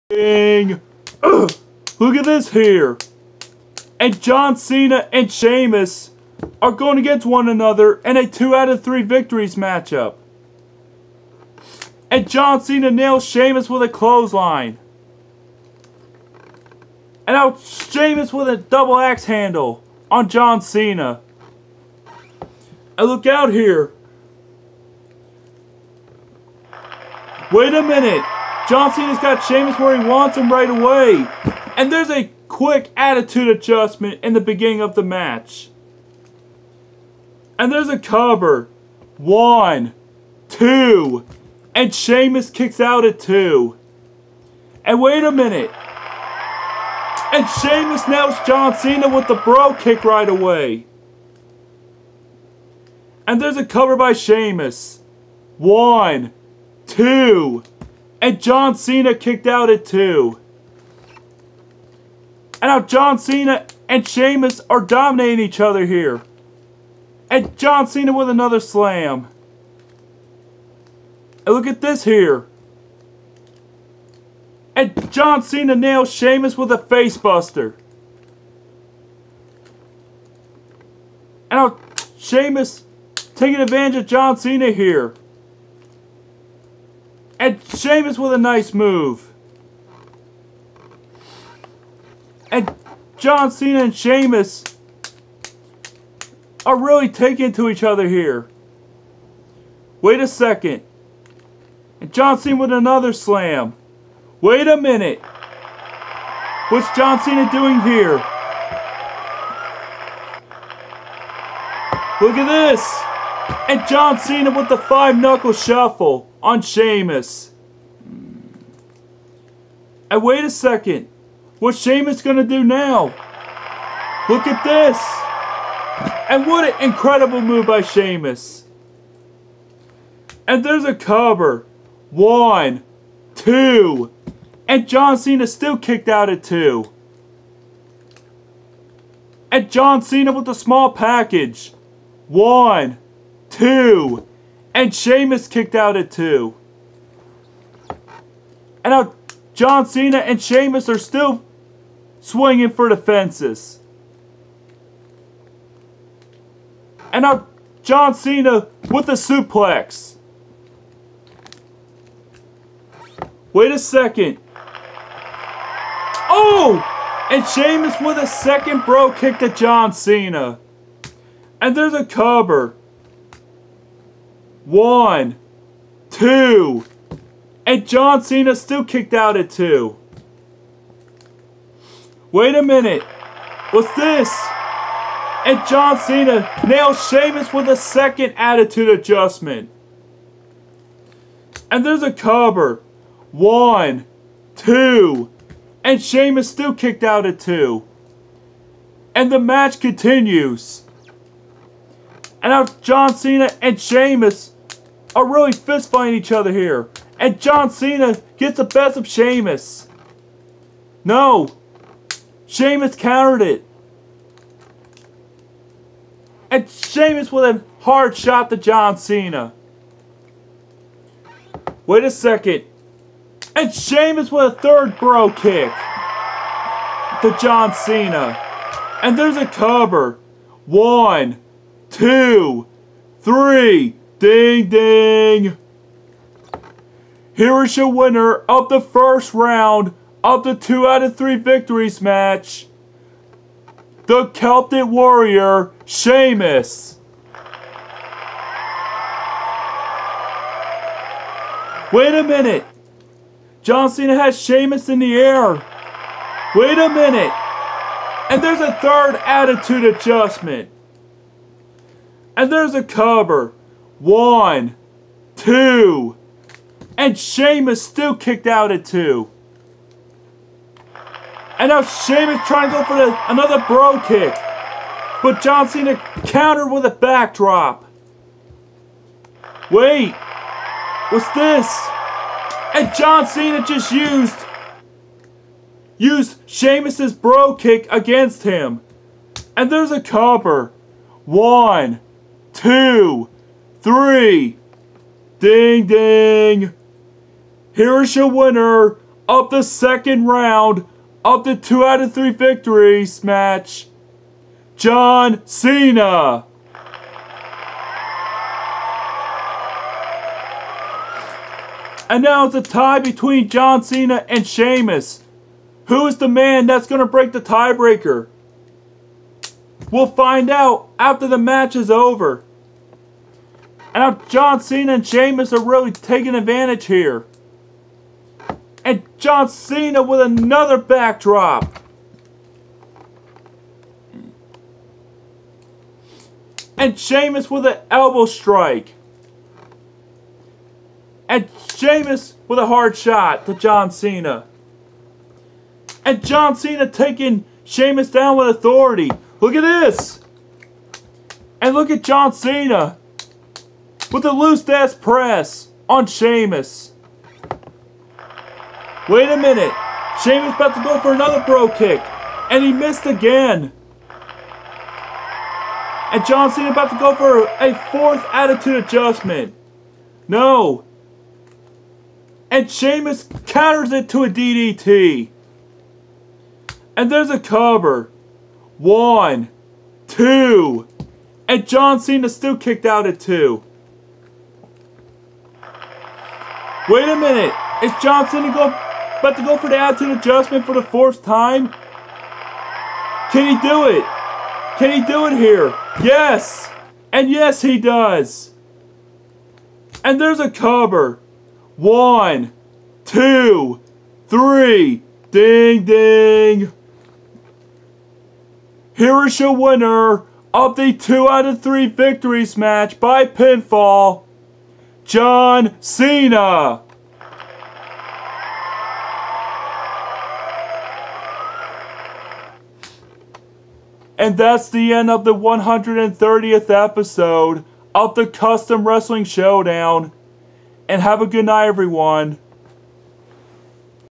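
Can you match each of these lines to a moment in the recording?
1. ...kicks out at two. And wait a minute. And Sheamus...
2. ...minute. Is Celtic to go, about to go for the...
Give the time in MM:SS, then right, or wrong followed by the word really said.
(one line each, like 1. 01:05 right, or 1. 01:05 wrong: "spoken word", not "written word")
1. 00:42 right
2. 06:27 wrong: "Johnson", not "Celtic".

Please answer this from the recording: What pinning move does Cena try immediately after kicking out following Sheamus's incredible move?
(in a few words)
Small package.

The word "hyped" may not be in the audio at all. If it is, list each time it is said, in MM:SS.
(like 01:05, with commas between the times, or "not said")
not said.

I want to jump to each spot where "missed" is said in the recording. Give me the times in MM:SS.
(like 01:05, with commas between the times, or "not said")
06:02.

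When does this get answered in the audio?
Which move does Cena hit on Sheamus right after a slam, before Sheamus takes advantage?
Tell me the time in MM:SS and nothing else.
01:16.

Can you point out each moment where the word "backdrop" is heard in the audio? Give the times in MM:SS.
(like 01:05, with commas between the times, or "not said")
04:36, 05:30.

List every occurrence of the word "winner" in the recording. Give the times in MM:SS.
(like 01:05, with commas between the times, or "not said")
03:57, 04:58, 06:49.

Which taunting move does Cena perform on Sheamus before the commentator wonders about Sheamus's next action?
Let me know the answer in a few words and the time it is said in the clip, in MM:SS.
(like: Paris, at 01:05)
Five knuckle shuffle, at 01:54.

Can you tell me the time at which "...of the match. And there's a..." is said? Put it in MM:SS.
00:34.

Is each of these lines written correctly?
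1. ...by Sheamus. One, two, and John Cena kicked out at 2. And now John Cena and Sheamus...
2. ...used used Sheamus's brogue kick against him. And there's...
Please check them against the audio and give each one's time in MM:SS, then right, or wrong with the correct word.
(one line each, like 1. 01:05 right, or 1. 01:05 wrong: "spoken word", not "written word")
1. 00:53 right
2. 04:43 right.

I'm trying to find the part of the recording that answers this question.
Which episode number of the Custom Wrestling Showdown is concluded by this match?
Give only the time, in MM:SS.
07:05.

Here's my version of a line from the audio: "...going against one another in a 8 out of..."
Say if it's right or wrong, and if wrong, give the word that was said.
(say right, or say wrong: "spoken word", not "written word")
wrong: "2", not "8".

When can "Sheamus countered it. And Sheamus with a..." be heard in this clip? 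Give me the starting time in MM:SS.
03:32.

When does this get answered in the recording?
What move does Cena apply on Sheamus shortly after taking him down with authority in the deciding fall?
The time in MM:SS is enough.
05:54.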